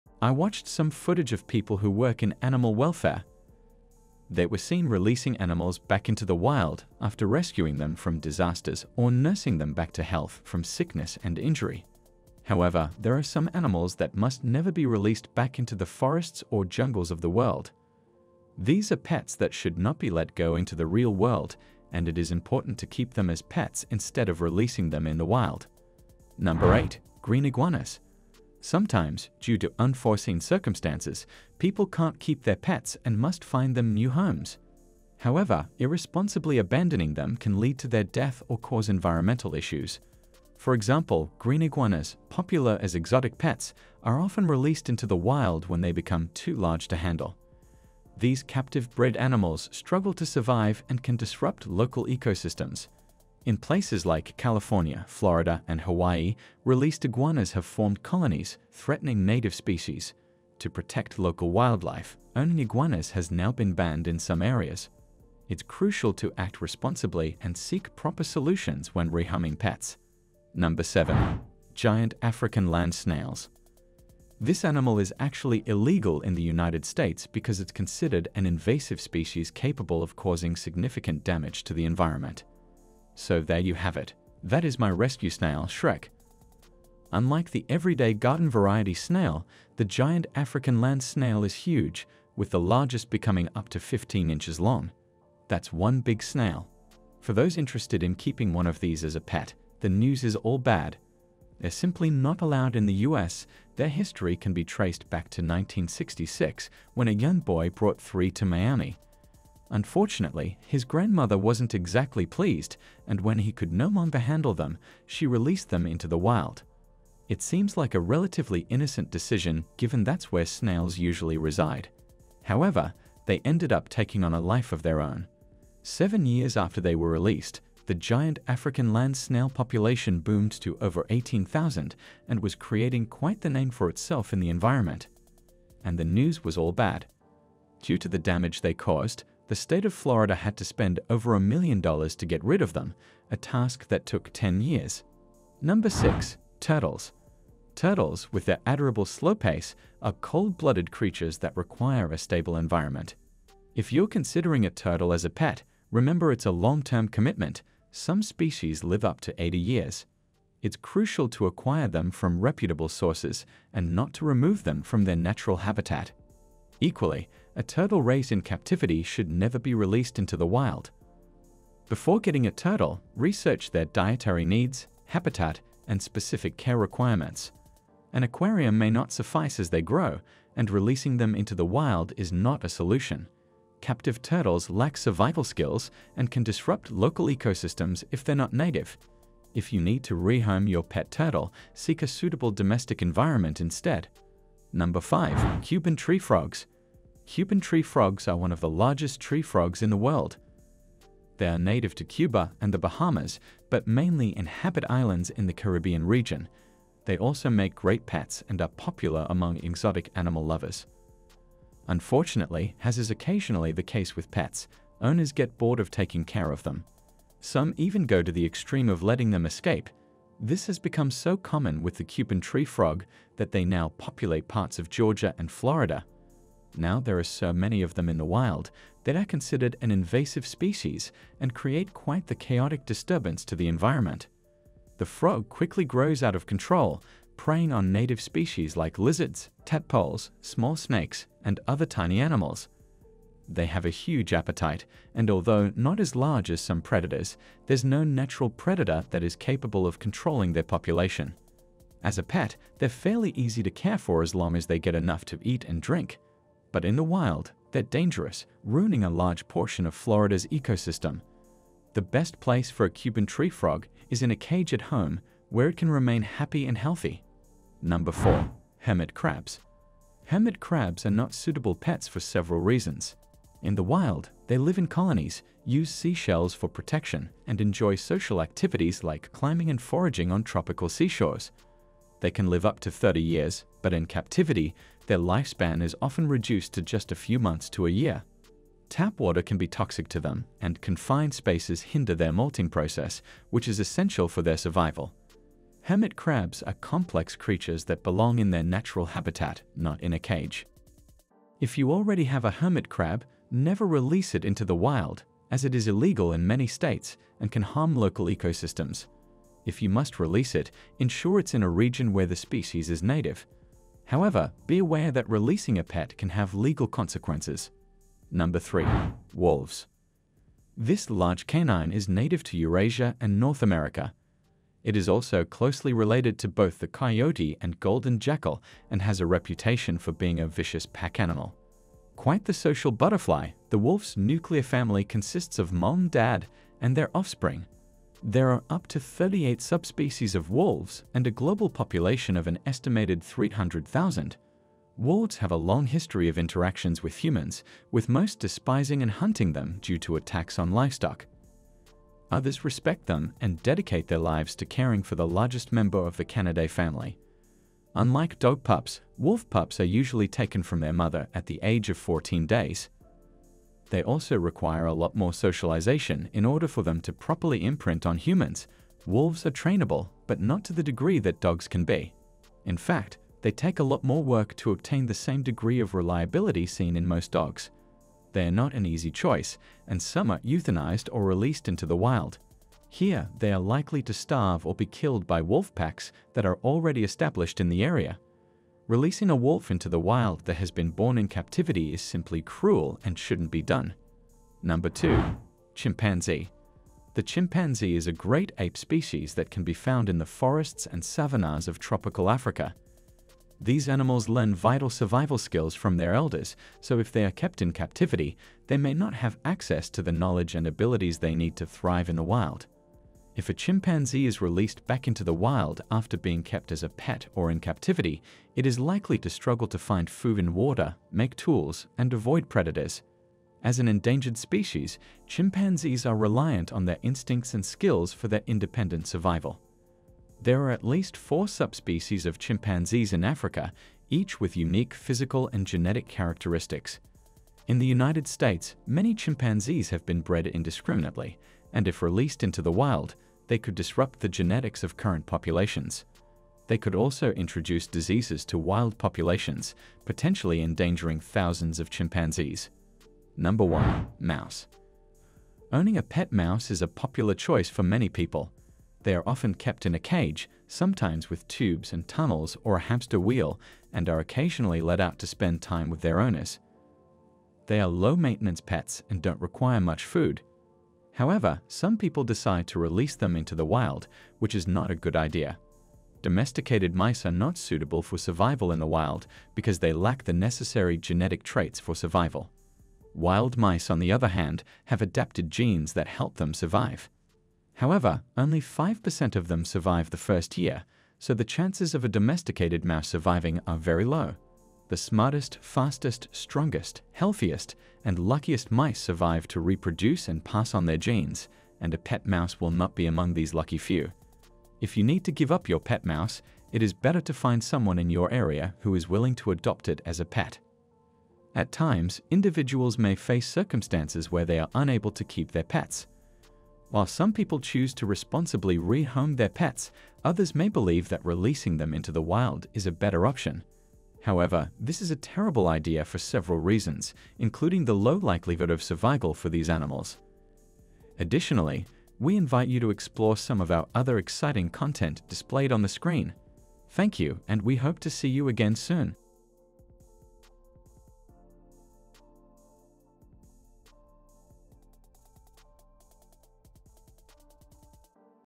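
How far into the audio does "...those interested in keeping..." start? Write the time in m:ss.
1:37.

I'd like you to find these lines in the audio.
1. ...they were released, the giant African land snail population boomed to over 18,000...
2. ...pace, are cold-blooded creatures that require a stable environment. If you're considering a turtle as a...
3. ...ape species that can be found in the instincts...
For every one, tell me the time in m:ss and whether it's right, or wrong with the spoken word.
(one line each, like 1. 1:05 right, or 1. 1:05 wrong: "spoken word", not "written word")
1. 2:06 right
2. 2:29 right
3. 6:38 wrong: "forests", not "instincts".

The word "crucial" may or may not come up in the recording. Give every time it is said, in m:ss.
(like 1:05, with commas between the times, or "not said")
1:05, 2:40.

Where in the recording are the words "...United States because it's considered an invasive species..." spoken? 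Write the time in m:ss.
1:16.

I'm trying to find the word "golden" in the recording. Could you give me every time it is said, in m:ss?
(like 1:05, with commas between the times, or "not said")
5:27.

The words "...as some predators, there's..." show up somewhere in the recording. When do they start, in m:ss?
4:06.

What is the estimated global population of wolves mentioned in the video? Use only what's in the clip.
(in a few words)
300,000.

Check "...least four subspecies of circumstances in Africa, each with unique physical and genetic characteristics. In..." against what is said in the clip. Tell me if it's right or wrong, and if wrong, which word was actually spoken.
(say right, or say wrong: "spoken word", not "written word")
wrong: "chimpanzees", not "circumstances".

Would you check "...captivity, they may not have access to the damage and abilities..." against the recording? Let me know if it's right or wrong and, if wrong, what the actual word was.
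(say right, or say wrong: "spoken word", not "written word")
wrong: "knowledge", not "damage".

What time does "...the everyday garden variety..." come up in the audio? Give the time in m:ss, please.
1:27.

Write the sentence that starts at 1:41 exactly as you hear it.
They're simply not allowed in the US.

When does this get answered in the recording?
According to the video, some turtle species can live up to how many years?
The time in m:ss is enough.
2:39.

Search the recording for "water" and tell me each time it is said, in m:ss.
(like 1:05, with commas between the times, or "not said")
4:49, 7:00.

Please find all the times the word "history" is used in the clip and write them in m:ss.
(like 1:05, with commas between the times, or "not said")
1:43, 5:45.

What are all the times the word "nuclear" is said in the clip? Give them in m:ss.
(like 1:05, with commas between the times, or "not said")
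5:34.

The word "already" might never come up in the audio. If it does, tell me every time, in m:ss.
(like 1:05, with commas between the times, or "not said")
5:01, 6:26.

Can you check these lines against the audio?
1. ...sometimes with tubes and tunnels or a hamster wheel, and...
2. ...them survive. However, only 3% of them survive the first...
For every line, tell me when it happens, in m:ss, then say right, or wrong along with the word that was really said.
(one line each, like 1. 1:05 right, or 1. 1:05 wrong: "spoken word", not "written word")
1. 7:40 right
2. 8:06 wrong: "5", not "3".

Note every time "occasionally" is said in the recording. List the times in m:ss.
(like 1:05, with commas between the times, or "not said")
3:33, 7:44.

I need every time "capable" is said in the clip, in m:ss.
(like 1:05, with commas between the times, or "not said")
1:19, 4:09.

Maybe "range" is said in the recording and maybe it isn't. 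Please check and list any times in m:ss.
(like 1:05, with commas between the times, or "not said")
not said.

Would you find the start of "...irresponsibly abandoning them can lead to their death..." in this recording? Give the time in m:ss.
0:35.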